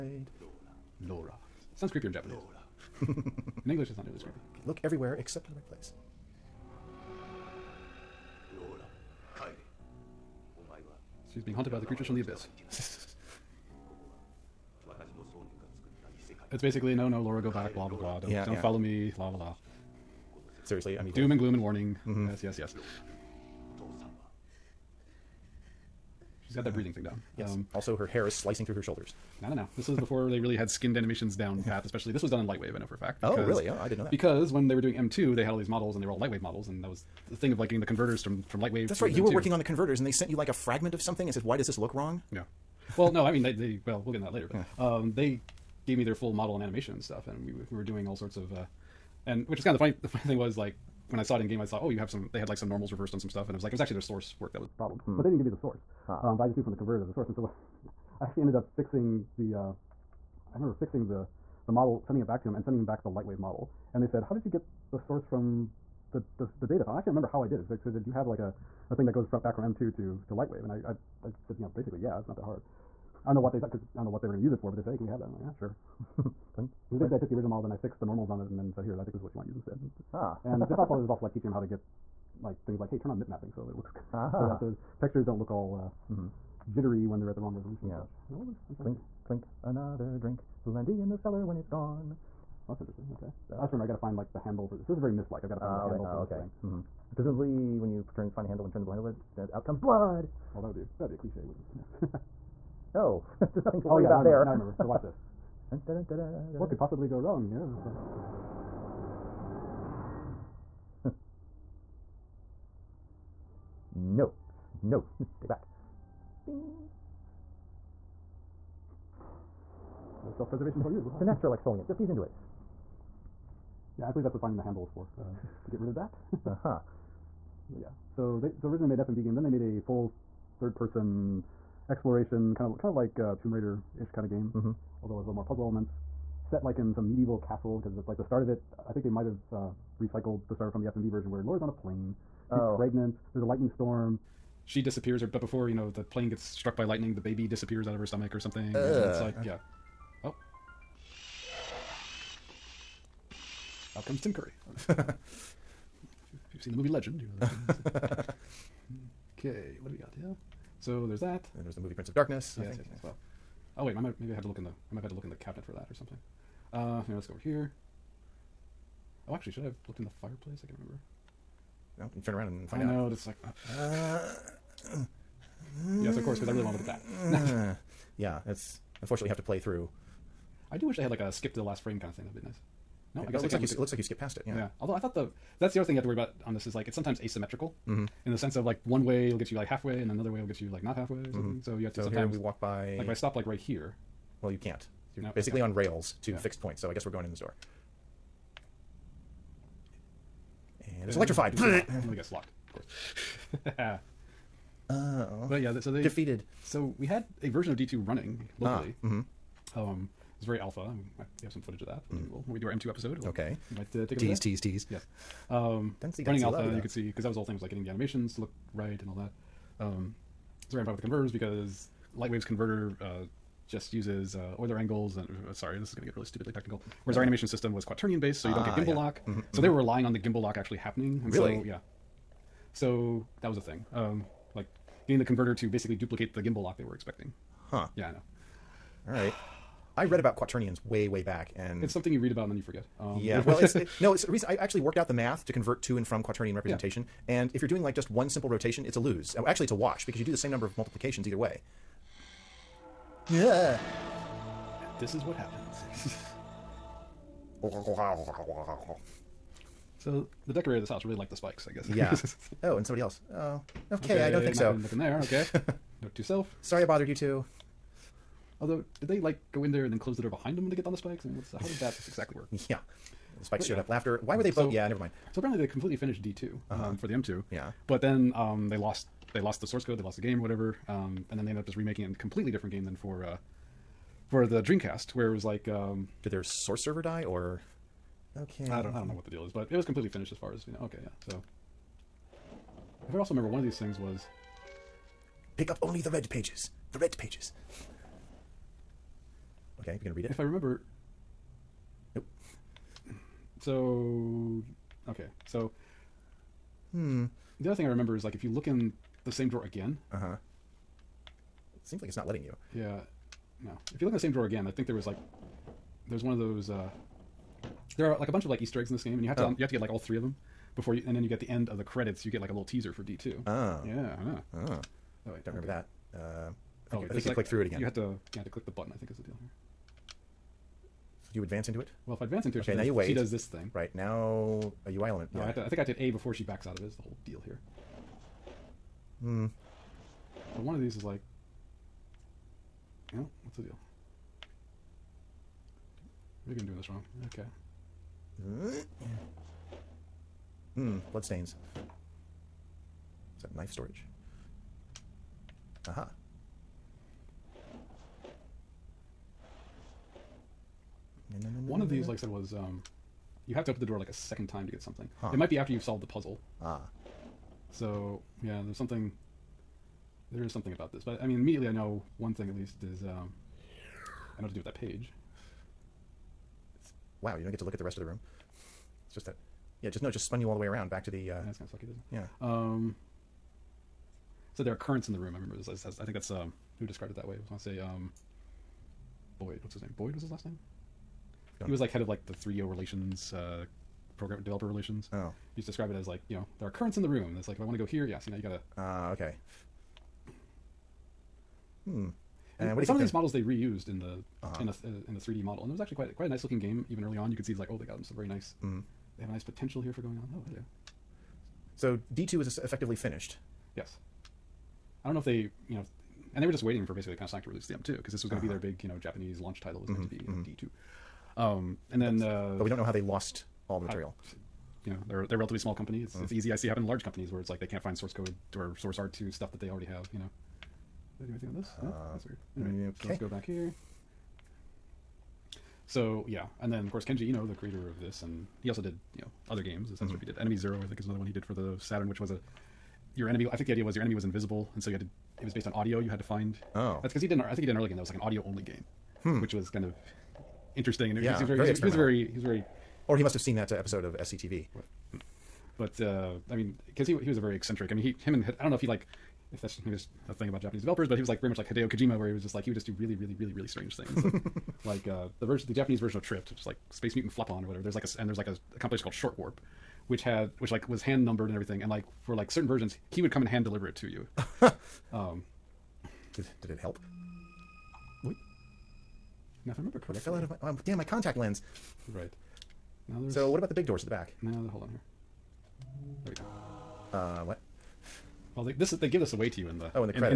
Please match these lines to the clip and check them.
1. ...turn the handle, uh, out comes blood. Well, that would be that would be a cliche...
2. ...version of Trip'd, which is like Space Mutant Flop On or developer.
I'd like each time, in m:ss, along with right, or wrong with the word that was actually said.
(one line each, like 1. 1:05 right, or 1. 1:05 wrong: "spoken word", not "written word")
1. 1:38 right
2. 7:45 wrong: "whatever", not "developer".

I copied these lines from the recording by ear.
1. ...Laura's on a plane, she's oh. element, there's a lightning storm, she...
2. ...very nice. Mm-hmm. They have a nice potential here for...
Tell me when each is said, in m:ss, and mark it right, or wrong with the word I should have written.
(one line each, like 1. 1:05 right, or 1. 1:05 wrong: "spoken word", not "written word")
1. 2:21 wrong: "pregnant", not "element"
2. 6:48 right.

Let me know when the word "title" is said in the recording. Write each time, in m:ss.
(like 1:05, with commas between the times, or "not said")
6:59.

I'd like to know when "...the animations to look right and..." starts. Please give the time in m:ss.
3:37.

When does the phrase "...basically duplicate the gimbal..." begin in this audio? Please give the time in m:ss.
3:55.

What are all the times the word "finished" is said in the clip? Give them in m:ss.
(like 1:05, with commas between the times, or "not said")
4:35, 4:50, 6:52.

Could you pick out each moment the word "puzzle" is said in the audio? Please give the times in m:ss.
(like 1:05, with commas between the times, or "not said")
2:15, 6:06.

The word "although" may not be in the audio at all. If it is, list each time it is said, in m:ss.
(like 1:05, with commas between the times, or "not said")
2:15, 3:04, 4:28.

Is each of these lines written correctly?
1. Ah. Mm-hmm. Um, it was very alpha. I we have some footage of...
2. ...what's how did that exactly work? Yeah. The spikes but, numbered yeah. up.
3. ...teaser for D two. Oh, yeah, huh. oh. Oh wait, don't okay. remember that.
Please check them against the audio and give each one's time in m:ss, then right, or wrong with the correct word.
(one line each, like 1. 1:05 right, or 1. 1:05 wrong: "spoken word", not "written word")
1. 3:28 right
2. 4:31 wrong: "showed", not "numbered"
3. 5:22 right.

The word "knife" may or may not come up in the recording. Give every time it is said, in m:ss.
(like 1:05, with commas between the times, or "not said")
5:53.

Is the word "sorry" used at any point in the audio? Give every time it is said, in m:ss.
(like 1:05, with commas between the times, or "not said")
3:45, 4:26.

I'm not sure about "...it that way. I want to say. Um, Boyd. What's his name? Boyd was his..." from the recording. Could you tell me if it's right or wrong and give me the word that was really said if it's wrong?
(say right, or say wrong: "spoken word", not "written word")
right.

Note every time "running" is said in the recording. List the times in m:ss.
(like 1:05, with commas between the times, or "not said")
3:27, 3:36.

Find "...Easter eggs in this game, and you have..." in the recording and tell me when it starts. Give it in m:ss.
5:18.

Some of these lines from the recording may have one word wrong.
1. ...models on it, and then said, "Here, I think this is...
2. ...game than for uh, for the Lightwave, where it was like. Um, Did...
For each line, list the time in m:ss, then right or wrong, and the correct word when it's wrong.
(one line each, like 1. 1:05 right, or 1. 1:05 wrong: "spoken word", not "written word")
1. 1:18 wrong: "normals", not "models"
2. 4:42 wrong: "Dreamcast", not "Lightwave".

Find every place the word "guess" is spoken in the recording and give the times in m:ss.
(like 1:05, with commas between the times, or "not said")
3:03, 3:16, 3:22, 4:21.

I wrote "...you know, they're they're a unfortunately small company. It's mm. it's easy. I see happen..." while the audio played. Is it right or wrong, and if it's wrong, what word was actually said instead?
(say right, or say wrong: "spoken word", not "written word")
wrong: "relatively", not "unfortunately".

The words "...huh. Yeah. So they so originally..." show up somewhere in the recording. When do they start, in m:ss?
2:06.